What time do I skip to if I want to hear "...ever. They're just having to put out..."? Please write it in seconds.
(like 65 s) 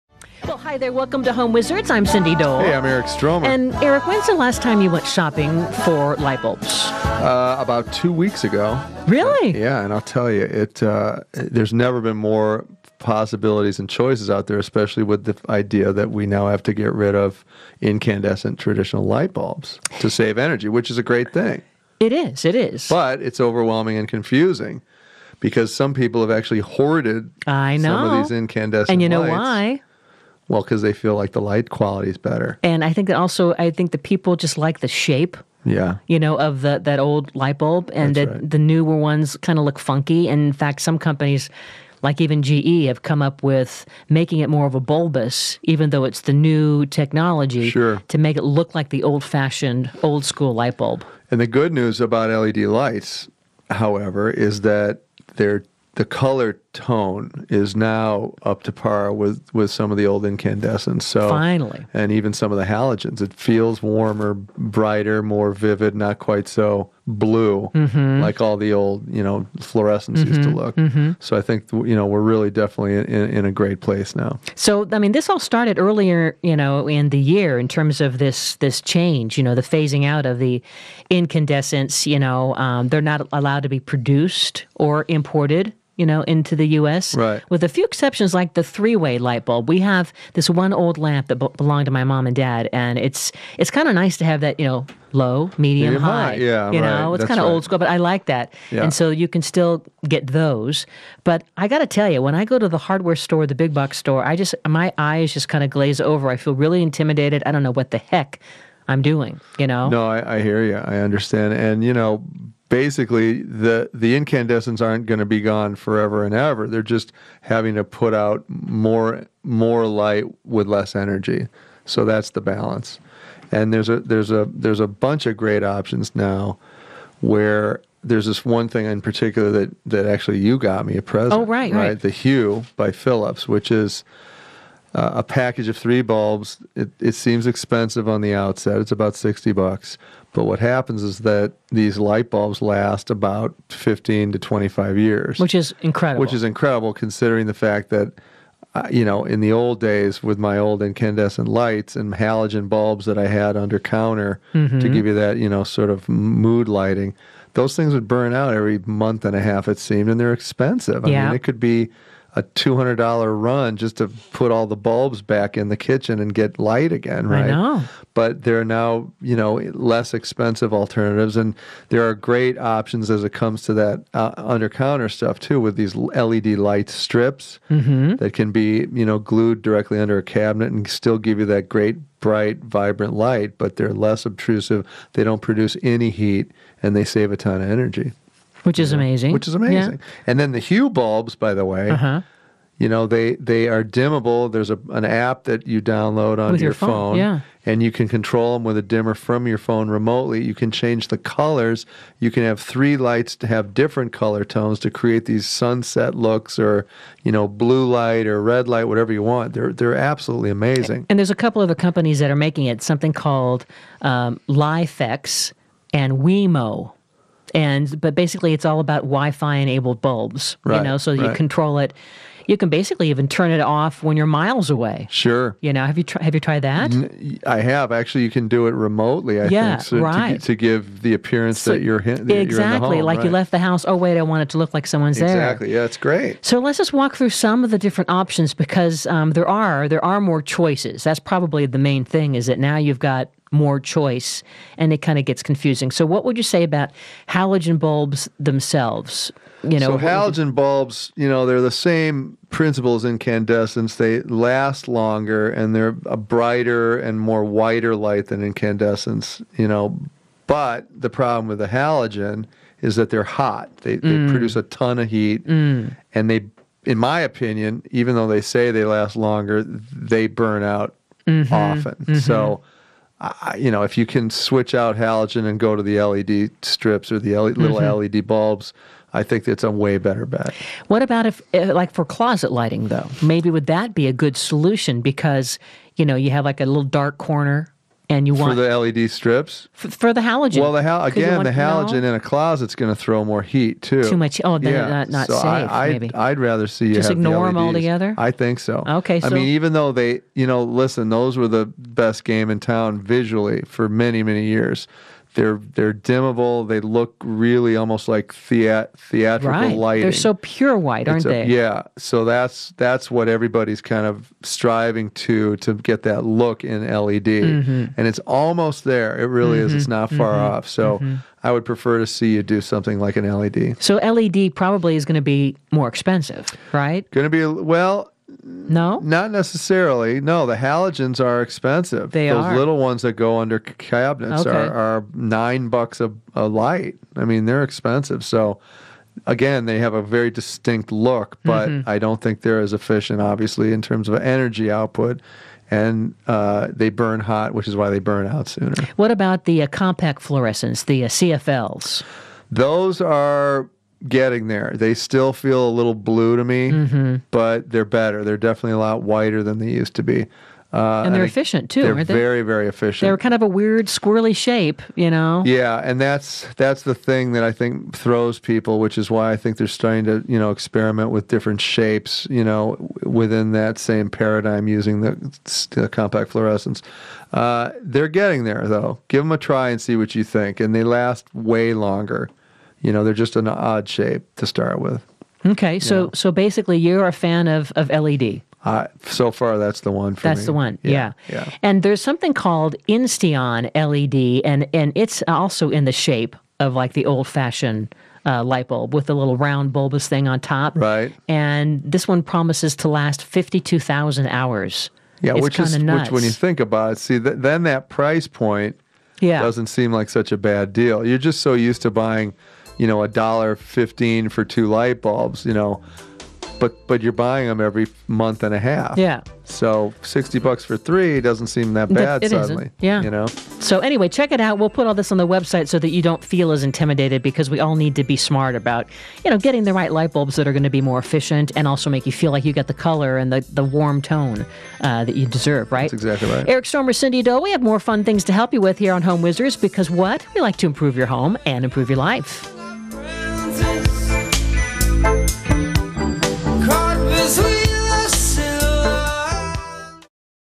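116 s.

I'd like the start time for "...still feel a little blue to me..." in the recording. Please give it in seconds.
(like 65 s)
354 s.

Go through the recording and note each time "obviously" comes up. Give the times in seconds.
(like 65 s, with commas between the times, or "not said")
343 s.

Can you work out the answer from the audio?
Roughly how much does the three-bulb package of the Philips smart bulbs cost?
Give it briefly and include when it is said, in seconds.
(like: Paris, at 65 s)
$60, at 138 s.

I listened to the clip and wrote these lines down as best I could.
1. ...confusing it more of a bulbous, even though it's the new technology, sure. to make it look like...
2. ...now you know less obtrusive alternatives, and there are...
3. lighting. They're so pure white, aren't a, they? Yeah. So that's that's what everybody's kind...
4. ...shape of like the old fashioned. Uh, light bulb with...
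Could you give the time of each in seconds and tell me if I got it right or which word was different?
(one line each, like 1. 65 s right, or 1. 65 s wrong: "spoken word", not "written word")
1. 44 s wrong: "making", not "confusing"
2. 168 s wrong: "expensive", not "obtrusive"
3. 309 s right
4. 395 s right.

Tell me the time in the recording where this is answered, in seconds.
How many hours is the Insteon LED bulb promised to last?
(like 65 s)
403 s.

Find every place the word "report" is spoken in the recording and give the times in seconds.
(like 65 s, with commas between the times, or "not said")
not said.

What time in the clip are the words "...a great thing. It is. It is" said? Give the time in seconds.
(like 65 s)
20 s.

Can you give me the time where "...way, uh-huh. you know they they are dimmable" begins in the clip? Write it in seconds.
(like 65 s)
191 s.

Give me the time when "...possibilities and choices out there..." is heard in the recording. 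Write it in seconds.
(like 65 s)
12 s.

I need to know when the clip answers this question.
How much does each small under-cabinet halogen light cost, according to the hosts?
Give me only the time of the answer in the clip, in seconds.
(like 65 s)
335 s.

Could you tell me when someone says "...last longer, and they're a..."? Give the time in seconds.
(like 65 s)
254 s.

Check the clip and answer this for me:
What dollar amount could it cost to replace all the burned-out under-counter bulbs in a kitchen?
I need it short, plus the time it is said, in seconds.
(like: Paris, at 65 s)
$200, at 162 s.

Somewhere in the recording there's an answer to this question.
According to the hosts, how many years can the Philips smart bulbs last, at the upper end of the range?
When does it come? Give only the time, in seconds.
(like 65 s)
143 s.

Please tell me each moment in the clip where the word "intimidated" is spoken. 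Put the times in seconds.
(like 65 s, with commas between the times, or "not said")
106 s, 426 s.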